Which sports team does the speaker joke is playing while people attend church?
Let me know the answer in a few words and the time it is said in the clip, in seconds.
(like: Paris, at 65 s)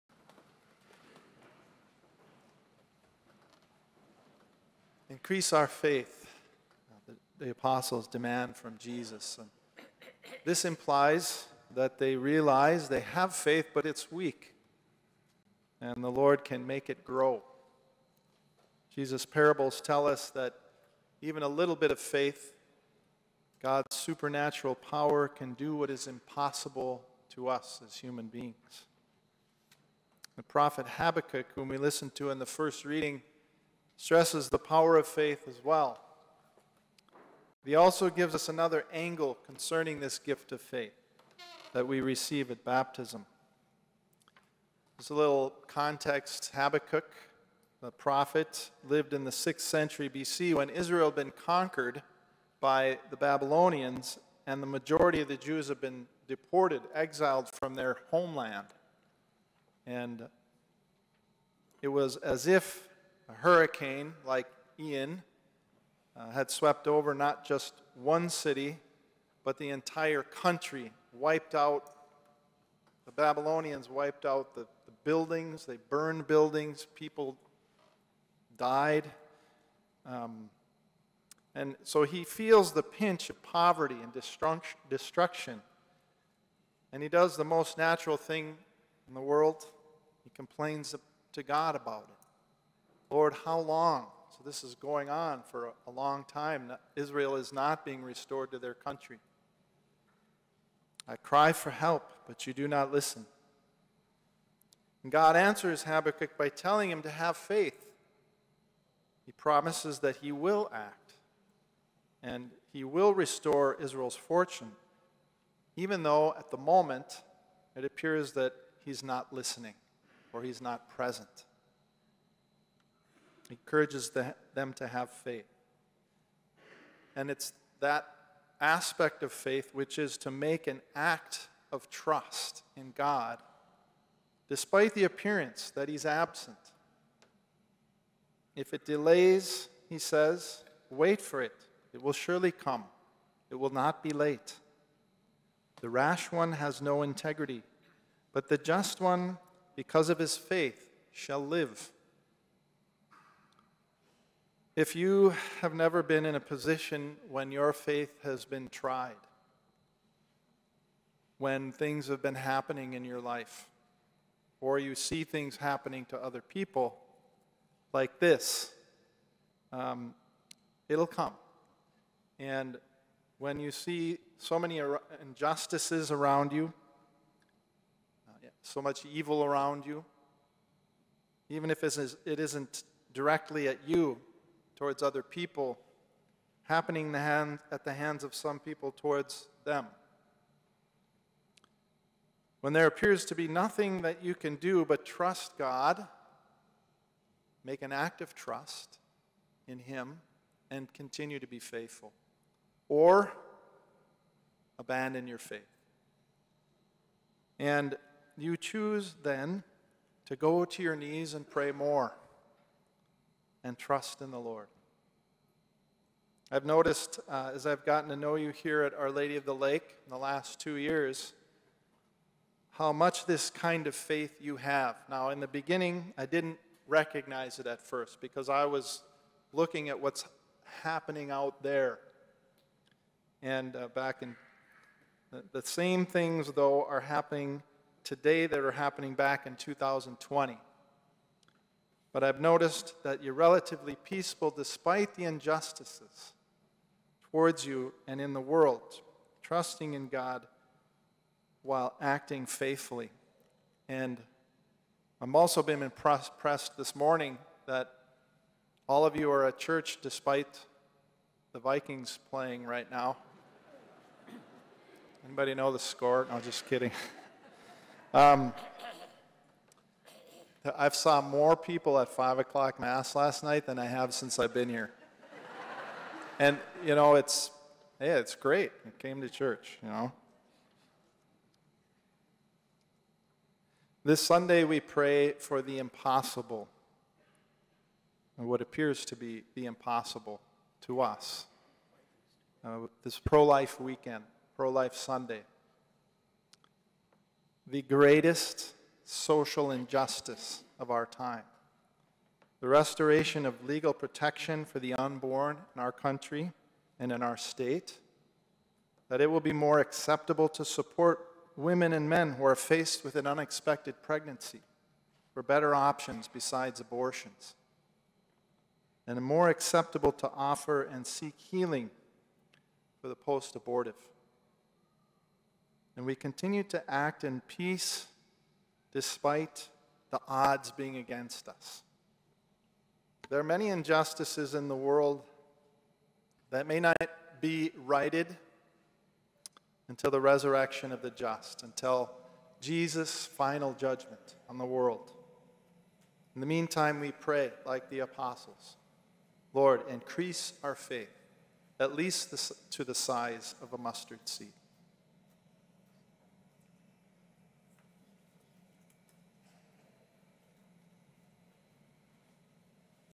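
Vikings, at 261 s.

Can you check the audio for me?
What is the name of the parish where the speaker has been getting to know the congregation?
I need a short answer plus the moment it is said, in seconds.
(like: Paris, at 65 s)
Our Lady of the Lake, at 218 s.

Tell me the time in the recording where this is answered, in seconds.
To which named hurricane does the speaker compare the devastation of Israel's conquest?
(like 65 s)
64 s.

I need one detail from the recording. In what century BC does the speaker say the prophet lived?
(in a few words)
6th century BC.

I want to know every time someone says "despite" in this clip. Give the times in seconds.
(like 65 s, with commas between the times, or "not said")
134 s, 244 s, 260 s, 328 s.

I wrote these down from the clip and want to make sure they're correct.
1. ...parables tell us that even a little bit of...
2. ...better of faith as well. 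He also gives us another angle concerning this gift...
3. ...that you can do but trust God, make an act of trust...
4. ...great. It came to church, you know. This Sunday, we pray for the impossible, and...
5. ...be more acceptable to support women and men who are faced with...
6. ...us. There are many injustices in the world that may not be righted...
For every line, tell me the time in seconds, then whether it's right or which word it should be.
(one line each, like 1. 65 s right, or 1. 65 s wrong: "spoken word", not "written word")
1. 19 s right
2. 34 s wrong: "power", not "better"
3. 194 s right
4. 278 s right
5. 309 s right
6. 331 s right.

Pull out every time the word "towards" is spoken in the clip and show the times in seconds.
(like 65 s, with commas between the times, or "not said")
184 s, 188 s, 247 s.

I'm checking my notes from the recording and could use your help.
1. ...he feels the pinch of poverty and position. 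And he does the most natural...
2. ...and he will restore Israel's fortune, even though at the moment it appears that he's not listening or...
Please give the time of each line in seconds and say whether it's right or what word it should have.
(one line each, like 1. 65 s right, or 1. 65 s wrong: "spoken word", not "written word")
1. 82 s wrong: "destruction", not "position"
2. 112 s right.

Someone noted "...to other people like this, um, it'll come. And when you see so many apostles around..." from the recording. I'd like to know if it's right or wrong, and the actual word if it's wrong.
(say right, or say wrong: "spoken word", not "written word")
wrong: "injustices", not "apostles".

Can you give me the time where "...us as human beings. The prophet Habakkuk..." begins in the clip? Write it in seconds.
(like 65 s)
27 s.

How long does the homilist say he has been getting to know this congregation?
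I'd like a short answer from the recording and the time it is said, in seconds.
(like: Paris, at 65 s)
2 years, at 220 s.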